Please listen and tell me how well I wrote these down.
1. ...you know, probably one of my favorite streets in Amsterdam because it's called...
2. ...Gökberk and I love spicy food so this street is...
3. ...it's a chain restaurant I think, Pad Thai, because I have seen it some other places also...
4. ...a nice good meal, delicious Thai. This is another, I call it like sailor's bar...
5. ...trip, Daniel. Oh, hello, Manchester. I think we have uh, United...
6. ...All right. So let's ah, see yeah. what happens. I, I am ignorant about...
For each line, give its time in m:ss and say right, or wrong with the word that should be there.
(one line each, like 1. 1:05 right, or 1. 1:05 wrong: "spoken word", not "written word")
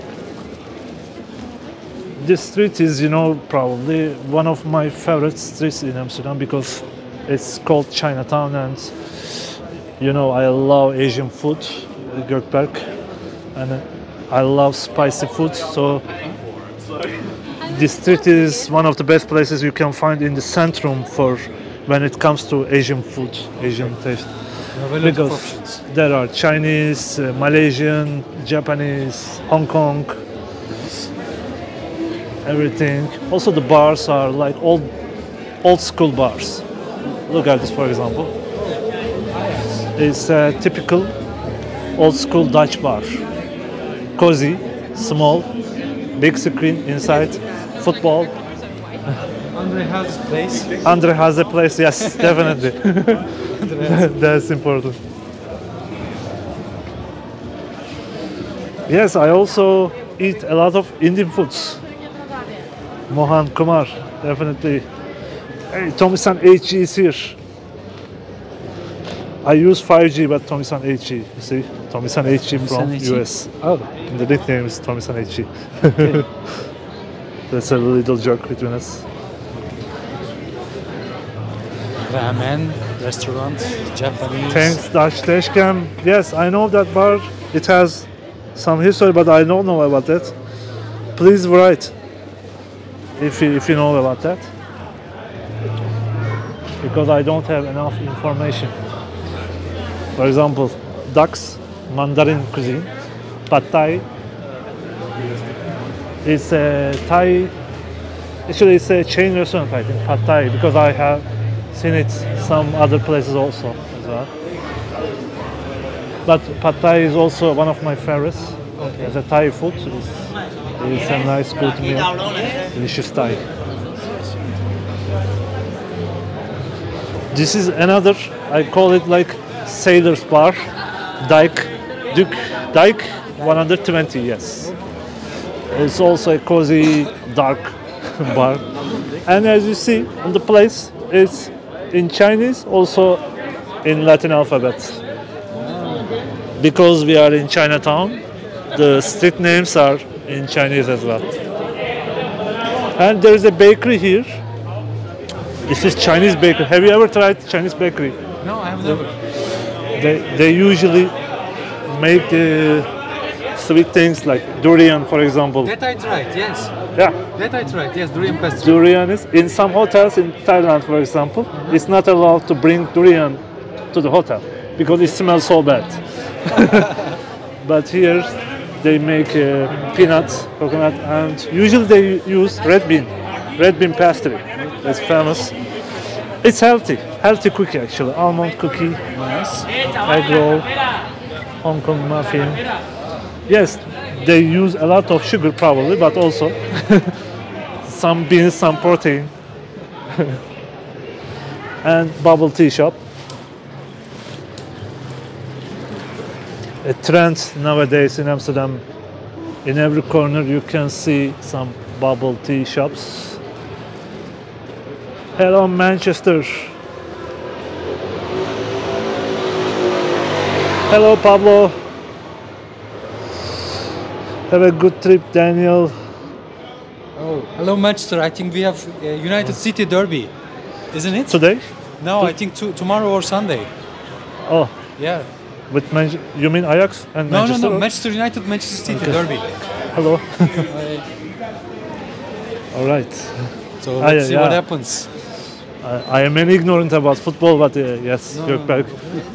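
1. 0:03 right
2. 0:12 right
3. 1:48 right
4. 2:01 right
5. 3:45 right
6. 4:02 right.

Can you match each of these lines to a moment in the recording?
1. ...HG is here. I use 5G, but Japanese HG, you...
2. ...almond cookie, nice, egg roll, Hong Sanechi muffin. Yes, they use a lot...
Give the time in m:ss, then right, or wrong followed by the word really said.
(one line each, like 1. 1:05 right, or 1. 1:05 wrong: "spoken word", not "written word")
1. 1:06 wrong: "Tomisan", not "Japanese"
2. 3:08 wrong: "Kong", not "Sanechi".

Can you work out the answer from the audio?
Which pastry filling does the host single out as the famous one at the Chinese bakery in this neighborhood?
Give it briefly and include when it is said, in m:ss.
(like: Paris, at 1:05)
Red bean, at 3:03.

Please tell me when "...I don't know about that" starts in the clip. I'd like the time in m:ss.
1:29.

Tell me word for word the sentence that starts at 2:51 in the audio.
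it's not allowed to bring durian to the hotel because it smells so bad.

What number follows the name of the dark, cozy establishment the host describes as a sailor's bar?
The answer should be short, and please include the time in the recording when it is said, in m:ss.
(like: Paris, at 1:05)
120, at 2:13.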